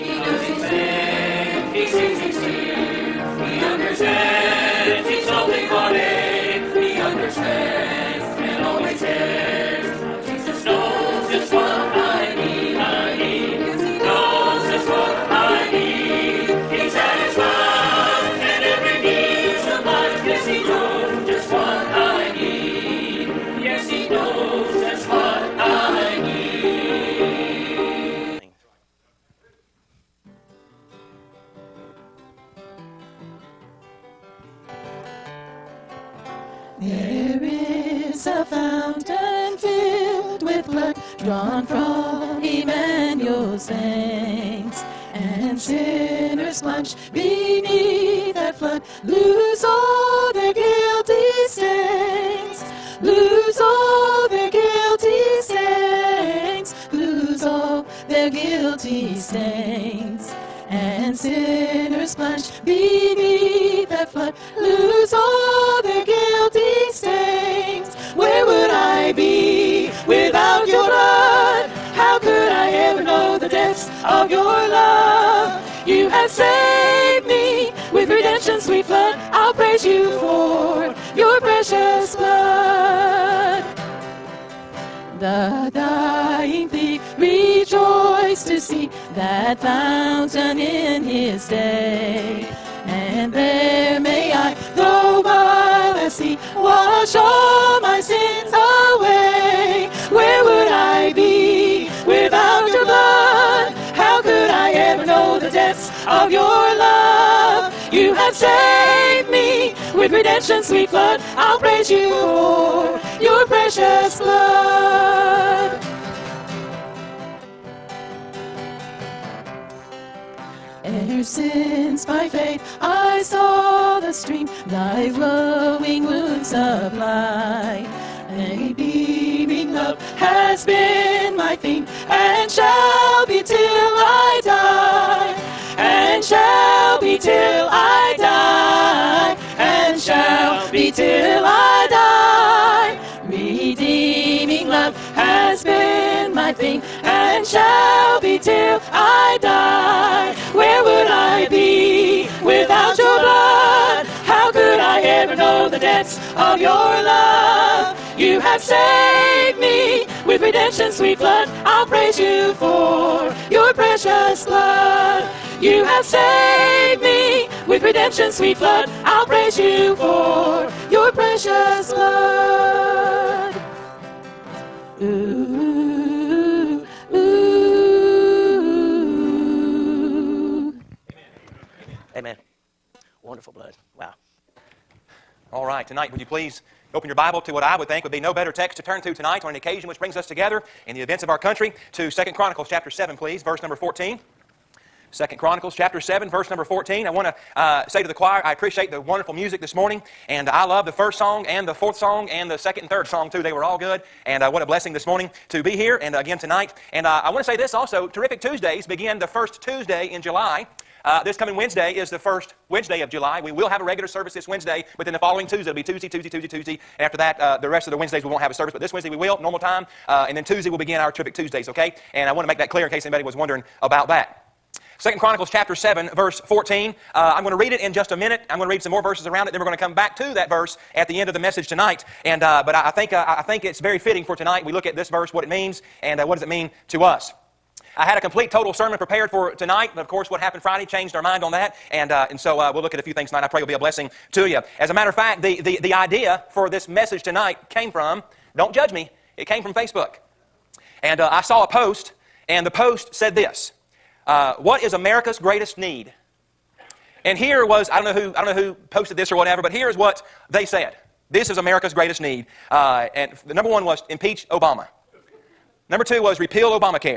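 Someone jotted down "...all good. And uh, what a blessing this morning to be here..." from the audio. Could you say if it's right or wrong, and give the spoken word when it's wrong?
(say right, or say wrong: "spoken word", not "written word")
right.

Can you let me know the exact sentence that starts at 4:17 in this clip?
And here was, I don't know who, I don't know who posted this or whatever, but here is what they said.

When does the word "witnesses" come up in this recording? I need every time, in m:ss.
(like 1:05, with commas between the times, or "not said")
not said.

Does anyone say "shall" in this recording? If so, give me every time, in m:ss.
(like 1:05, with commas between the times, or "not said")
2:19, 2:27.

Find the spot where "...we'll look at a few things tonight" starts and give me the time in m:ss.
4:02.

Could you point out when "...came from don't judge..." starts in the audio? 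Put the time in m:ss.
4:07.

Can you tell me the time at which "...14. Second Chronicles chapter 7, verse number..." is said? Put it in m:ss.
3:13.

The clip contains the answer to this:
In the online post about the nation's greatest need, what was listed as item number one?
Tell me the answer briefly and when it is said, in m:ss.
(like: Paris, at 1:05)
Impeach Obama, at 4:24.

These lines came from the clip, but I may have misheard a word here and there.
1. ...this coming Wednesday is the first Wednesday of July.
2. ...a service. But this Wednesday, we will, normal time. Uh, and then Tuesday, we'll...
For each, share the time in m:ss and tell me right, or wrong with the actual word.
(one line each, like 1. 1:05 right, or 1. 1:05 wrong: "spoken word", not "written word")
1. 3:31 right
2. 3:38 right.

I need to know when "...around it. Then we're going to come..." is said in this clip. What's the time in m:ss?
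3:49.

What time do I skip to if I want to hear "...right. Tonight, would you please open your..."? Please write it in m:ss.
3:05.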